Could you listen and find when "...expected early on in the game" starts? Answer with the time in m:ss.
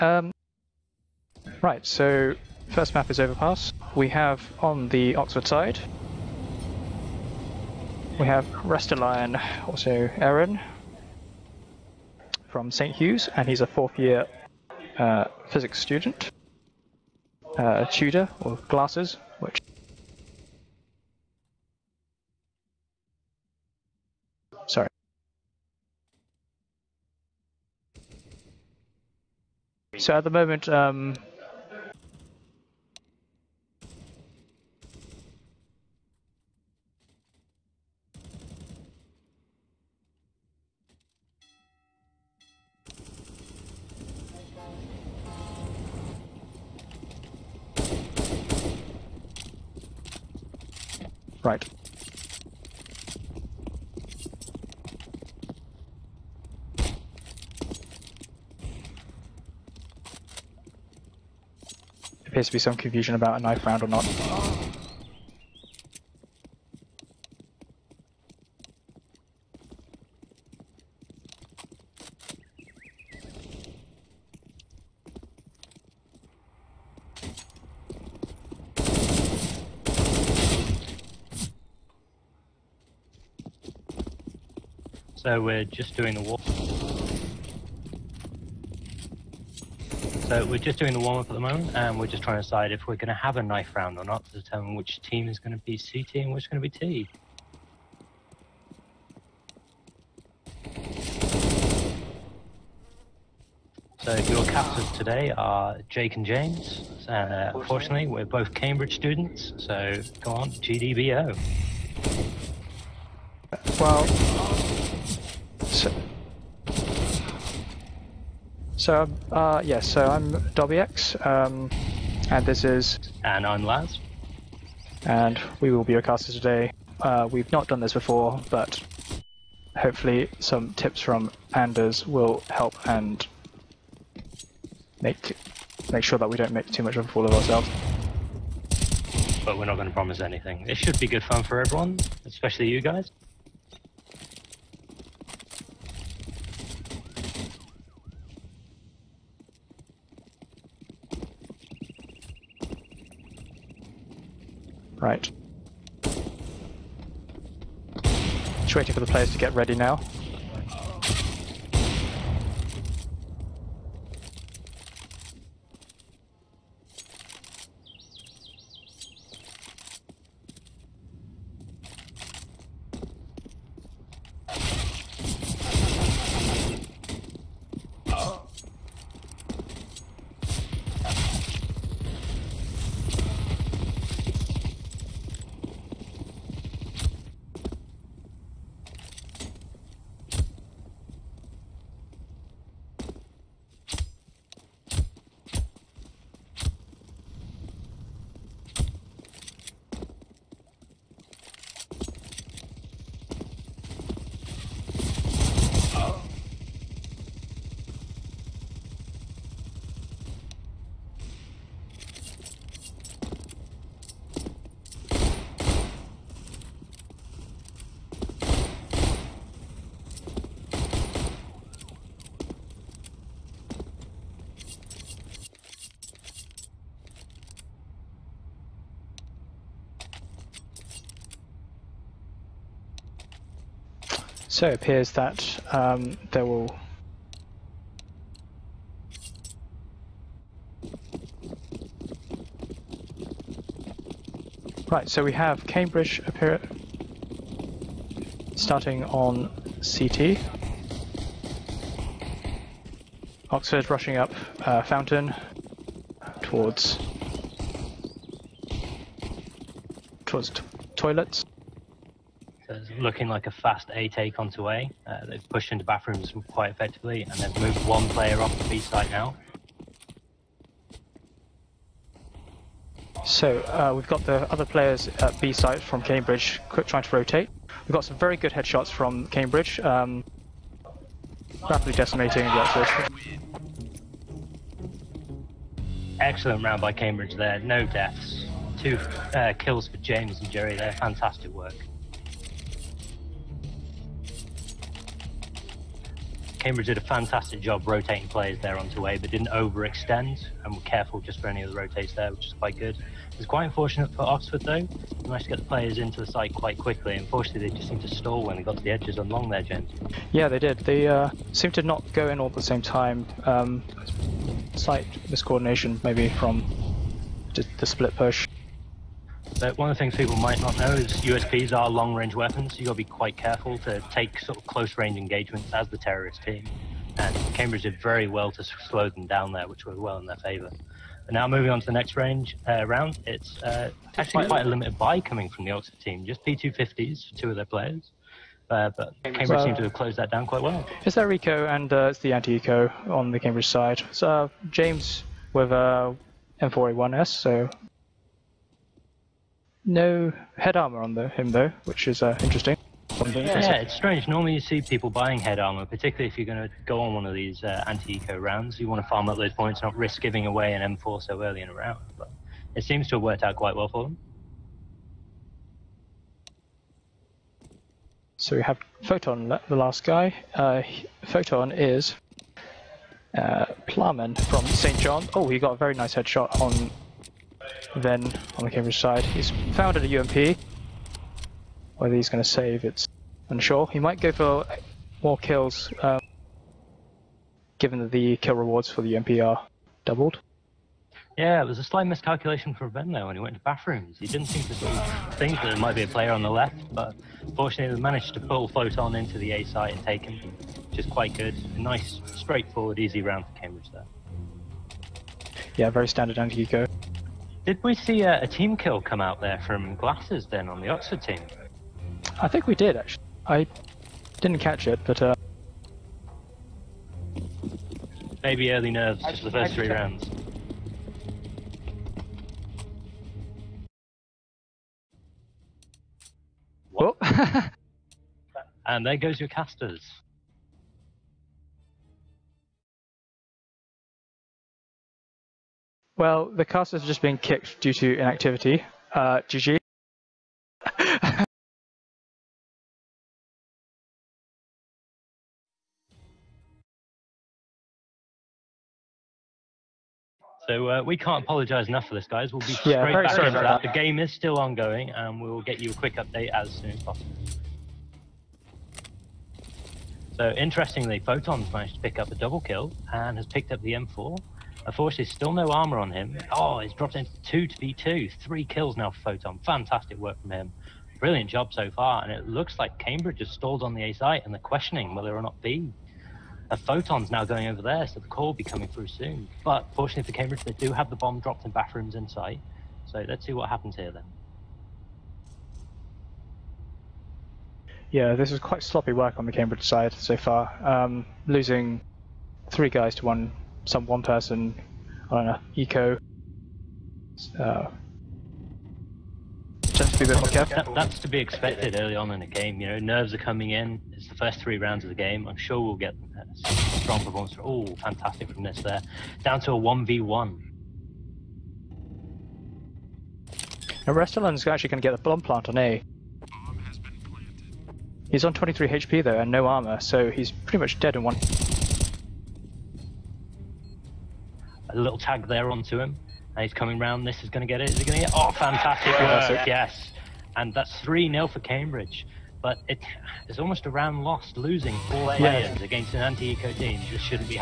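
8:21.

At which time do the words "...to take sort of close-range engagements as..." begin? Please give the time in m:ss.
5:23.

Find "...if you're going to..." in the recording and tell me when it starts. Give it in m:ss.
5:56.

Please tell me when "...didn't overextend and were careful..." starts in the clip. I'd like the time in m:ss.
4:59.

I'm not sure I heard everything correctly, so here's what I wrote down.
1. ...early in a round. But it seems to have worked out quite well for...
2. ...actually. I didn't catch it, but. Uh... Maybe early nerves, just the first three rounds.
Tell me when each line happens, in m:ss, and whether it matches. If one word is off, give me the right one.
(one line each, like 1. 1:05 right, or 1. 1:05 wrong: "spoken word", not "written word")
1. 6:01 right
2. 6:52 right.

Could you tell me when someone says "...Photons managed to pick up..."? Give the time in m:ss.
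7:41.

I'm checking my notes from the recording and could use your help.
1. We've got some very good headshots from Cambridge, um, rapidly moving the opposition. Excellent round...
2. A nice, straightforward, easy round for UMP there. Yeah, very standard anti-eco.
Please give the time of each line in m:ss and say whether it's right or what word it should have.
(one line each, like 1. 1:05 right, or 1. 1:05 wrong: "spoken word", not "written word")
1. 4:37 wrong: "decimating", not "moving"
2. 6:41 wrong: "Cambridge", not "UMP".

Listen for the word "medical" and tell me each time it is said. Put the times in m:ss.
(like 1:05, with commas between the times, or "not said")
not said.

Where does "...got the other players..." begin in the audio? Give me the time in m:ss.
4:34.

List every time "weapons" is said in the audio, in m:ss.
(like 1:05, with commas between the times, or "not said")
5:22.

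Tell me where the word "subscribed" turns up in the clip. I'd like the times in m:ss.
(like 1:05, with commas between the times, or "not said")
not said.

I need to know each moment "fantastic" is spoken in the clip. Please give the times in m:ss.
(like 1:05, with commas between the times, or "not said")
4:50, 4:57, 7:49, 8:27, 8:48.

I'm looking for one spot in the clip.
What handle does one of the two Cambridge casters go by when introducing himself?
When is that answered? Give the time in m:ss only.
2:00.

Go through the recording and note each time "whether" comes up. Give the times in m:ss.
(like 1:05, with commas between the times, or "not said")
6:21, 7:55.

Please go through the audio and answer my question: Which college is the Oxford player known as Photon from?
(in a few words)
St. John's.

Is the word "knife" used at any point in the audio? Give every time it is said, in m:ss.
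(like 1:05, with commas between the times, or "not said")
1:03, 1:33.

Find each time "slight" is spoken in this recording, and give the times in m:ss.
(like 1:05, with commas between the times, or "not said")
5:14, 6:31.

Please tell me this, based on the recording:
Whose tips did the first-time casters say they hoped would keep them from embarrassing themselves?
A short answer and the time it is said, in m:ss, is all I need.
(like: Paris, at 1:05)
Anders, at 2:11.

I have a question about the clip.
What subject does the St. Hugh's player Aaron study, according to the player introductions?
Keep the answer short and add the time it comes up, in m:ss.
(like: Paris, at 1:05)
Physics, at 0:15.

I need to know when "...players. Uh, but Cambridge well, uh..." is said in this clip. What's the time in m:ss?
5:37.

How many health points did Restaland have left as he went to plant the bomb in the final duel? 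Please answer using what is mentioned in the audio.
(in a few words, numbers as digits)
23.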